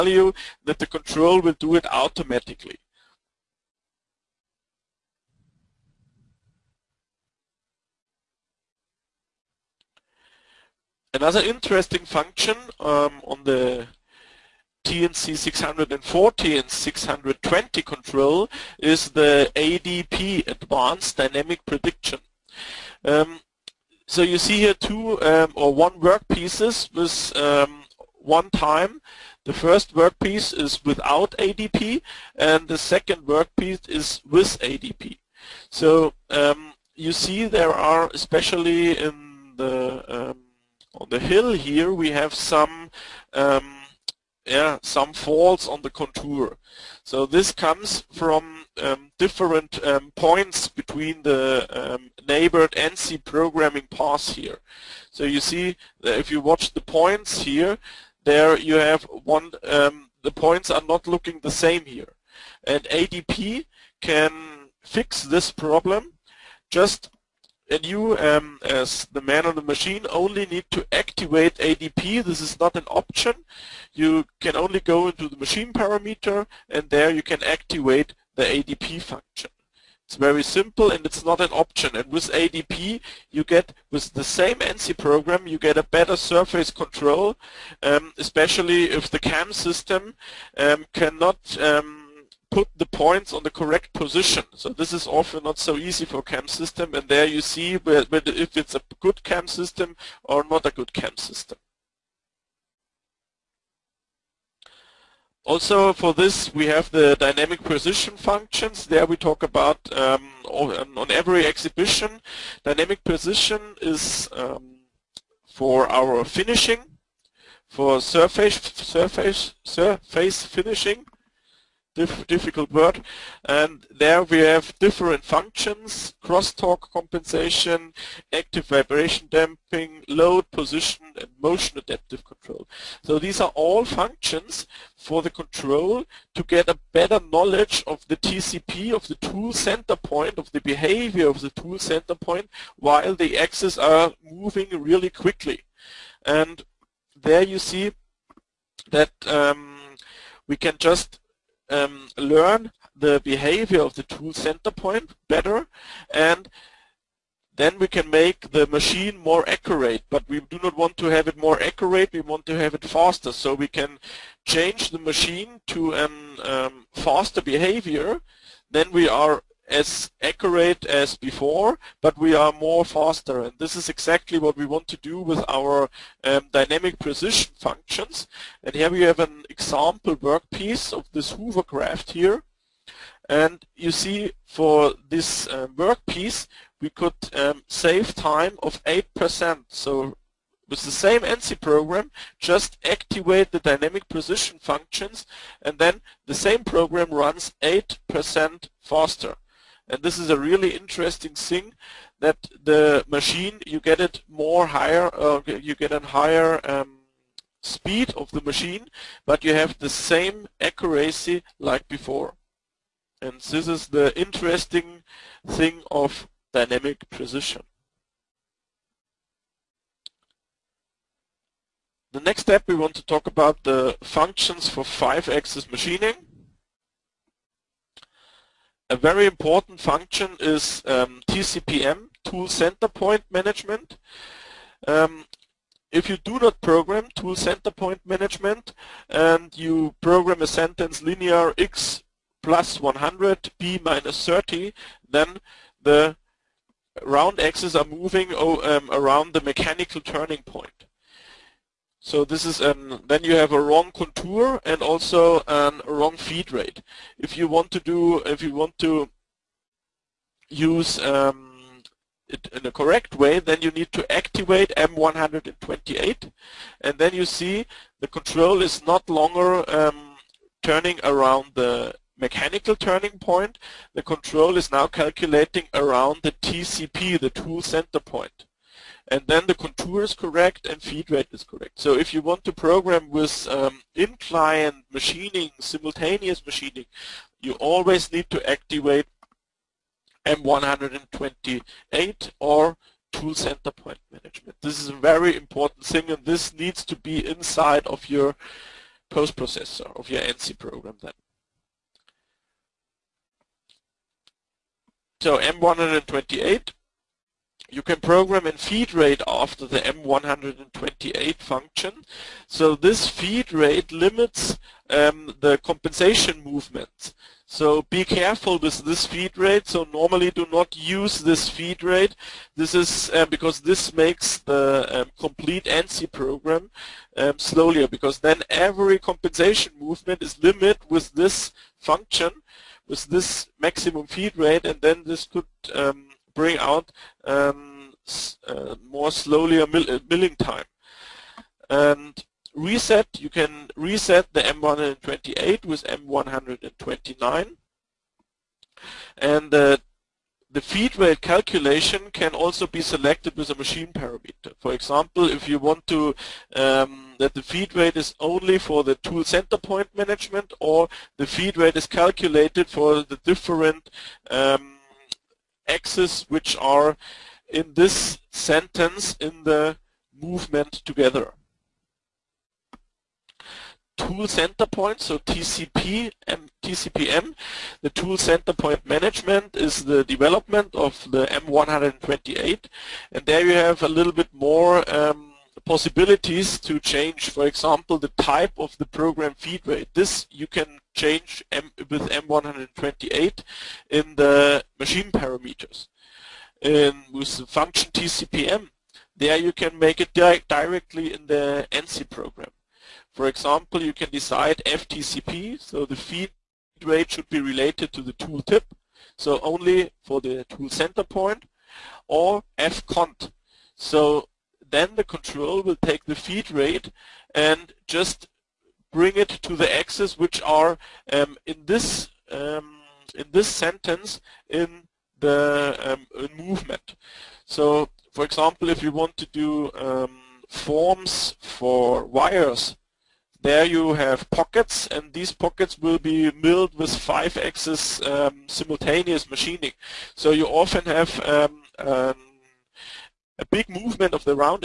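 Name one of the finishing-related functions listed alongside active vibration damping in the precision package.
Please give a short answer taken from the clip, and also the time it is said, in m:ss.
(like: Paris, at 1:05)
crosstalk compensation, at 2:06.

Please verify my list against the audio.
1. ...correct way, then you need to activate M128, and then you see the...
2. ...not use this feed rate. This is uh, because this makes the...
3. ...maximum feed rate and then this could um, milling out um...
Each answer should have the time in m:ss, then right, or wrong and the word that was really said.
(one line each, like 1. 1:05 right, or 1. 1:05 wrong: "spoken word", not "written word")
1. 4:22 right
2. 5:20 right
3. 5:33 wrong: "bring", not "milling".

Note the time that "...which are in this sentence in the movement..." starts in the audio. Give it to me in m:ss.
6:06.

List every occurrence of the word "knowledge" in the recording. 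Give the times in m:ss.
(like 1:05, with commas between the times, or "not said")
2:17.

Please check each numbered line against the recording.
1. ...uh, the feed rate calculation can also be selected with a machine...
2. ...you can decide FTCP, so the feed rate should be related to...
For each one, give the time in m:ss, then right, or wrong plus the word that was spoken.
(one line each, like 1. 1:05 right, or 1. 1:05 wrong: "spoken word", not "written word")
1. 5:49 right
2. 6:43 right.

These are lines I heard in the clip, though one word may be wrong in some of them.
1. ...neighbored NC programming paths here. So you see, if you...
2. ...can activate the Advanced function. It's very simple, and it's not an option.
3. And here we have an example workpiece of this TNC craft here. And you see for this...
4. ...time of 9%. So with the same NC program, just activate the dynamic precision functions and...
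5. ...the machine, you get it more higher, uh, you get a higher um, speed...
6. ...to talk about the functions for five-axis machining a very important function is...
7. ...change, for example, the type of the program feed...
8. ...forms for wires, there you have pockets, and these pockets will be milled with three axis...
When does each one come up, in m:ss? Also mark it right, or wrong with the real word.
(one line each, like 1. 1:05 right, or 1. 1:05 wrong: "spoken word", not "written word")
1. 0:52 right
2. 1:17 wrong: "ADP", not "Advanced"
3. 2:58 wrong: "Hoover", not "TNC"
4. 3:08 wrong: "8", not "9"
5. 3:22 right
6. 3:42 right
7. 6:26 right
8. 7:10 wrong: "five", not "three".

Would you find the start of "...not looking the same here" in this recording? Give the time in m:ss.
1:00.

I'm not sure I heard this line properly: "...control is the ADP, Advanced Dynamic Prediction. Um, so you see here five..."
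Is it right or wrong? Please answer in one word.
wrong.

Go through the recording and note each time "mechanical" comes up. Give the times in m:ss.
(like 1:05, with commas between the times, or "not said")
4:09, 4:32.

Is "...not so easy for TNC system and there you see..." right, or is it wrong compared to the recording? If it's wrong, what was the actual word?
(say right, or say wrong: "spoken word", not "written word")
wrong: "CAM", not "TNC".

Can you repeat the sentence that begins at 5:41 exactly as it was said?
And reset, you can reset the M128 with M129.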